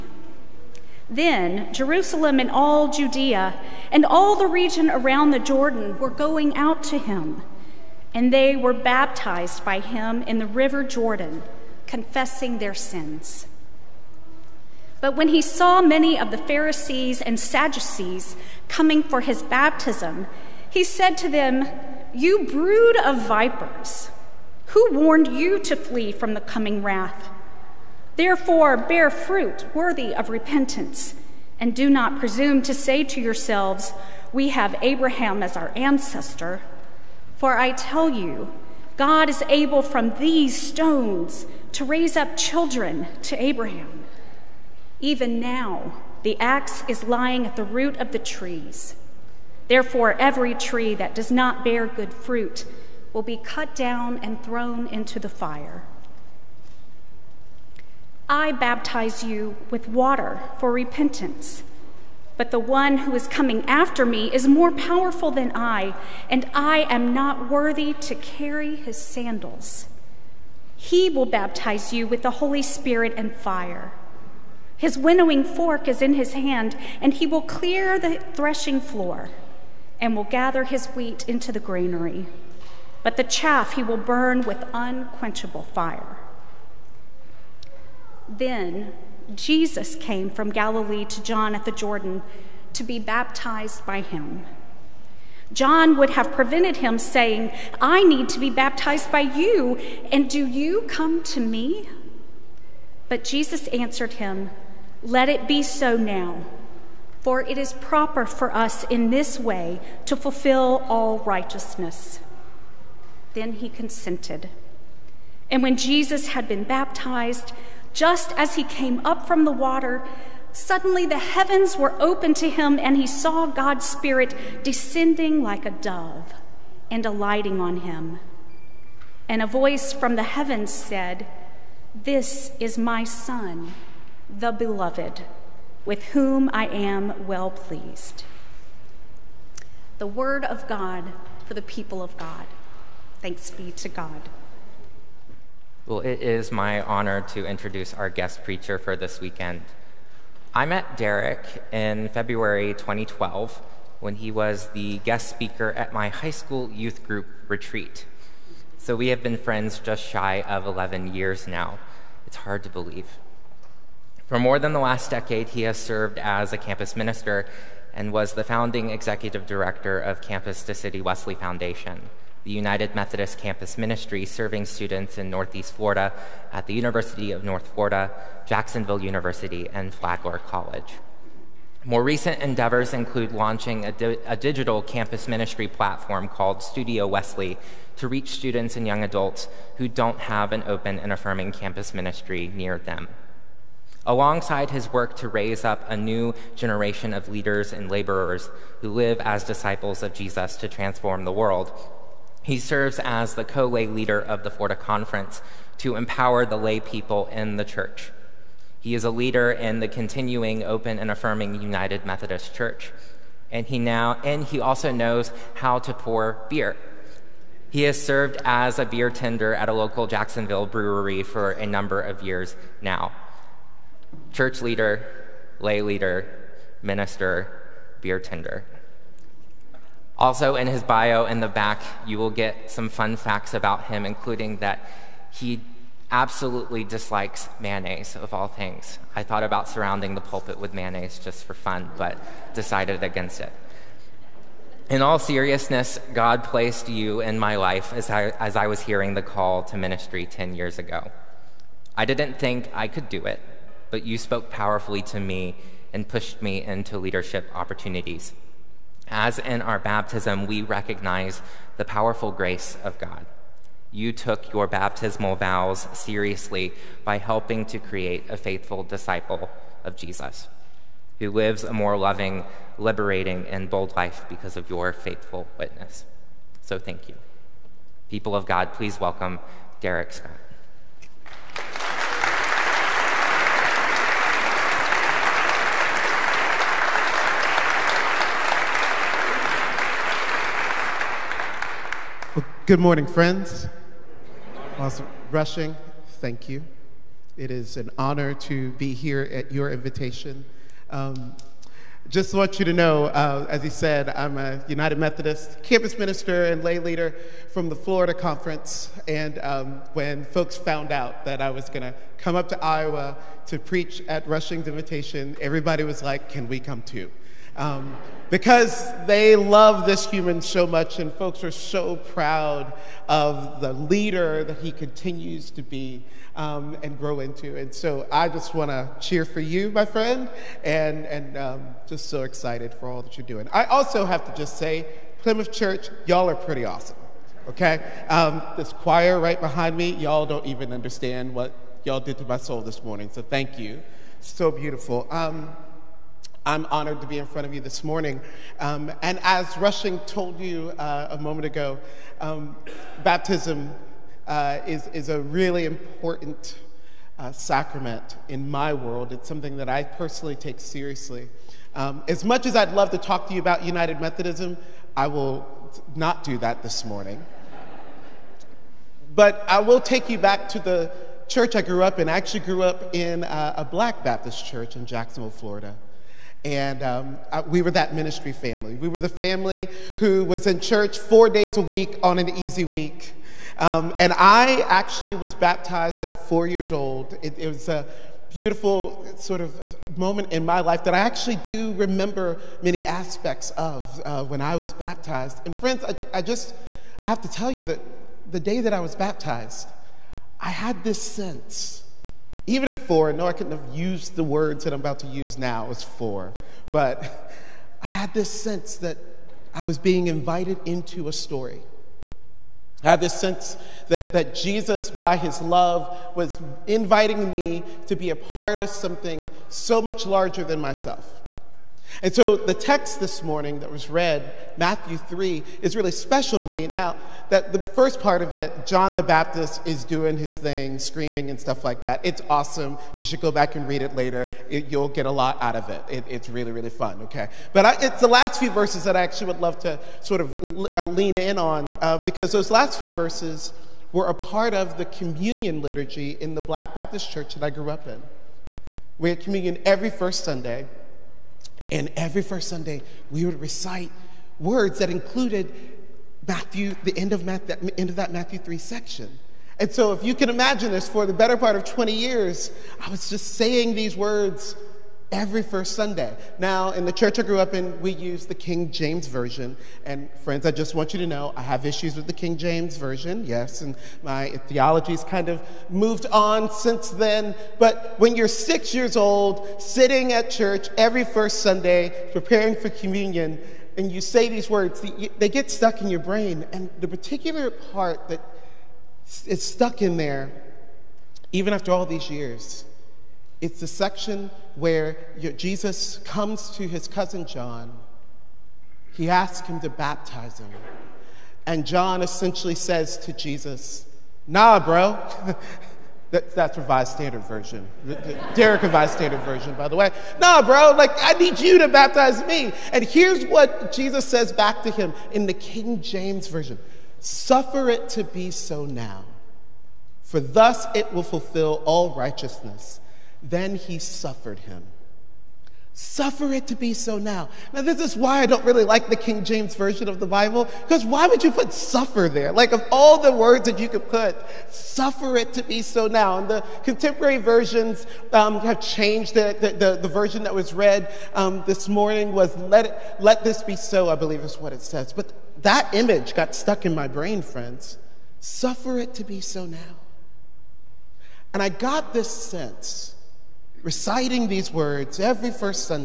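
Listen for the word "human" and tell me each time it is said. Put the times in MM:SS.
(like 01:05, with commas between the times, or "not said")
05:20.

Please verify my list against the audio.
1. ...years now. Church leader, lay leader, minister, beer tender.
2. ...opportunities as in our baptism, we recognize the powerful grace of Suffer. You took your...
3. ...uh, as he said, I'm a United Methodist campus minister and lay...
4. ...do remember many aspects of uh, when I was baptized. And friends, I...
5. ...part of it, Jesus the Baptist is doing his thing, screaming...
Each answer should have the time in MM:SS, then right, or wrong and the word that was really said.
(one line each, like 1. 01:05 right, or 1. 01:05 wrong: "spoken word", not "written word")
1. 03:42 right
2. 04:17 wrong: "God", not "Suffer"
3. 05:03 right
4. 06:31 right
5. 07:07 wrong: "John", not "Jesus".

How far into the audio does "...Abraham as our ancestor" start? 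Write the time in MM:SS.
00:34.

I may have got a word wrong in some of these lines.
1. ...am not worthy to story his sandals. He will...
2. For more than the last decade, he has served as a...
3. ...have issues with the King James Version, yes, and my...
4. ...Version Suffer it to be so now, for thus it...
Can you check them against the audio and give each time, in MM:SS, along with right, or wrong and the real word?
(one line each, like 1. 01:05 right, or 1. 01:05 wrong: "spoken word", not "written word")
1. 01:06 wrong: "carry", not "story"
2. 02:44 right
3. 07:51 right
4. 08:36 right.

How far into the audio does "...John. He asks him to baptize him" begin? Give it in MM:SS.
08:17.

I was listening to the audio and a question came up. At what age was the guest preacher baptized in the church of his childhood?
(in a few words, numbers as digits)
4.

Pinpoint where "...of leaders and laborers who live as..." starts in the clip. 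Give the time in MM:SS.
03:17.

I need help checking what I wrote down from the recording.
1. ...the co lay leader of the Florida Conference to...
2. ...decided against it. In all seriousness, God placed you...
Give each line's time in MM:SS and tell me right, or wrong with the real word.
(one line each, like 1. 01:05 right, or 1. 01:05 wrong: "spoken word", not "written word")
1. 03:23 right
2. 04:02 right.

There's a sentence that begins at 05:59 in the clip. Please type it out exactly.
It's something that I personally take seriously.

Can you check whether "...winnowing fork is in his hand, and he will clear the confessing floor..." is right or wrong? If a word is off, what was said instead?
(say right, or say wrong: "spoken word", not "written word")
wrong: "threshing", not "confessing".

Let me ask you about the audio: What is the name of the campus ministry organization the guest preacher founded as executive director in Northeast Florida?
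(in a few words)
Campus to City Wesley Foundation.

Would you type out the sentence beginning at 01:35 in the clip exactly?
John would have prevented him saying, I need to be baptized by you, and do you come to me?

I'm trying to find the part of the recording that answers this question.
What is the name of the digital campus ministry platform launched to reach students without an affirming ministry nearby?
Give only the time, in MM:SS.
03:06.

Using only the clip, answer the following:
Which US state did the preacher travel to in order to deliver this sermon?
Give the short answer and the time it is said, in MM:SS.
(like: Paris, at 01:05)
Iowa, at 05:12.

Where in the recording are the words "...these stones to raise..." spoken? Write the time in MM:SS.
00:40.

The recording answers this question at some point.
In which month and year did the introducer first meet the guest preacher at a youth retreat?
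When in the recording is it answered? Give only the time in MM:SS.
02:32.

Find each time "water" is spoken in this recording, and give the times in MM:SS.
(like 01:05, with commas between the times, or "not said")
00:59, 01:59.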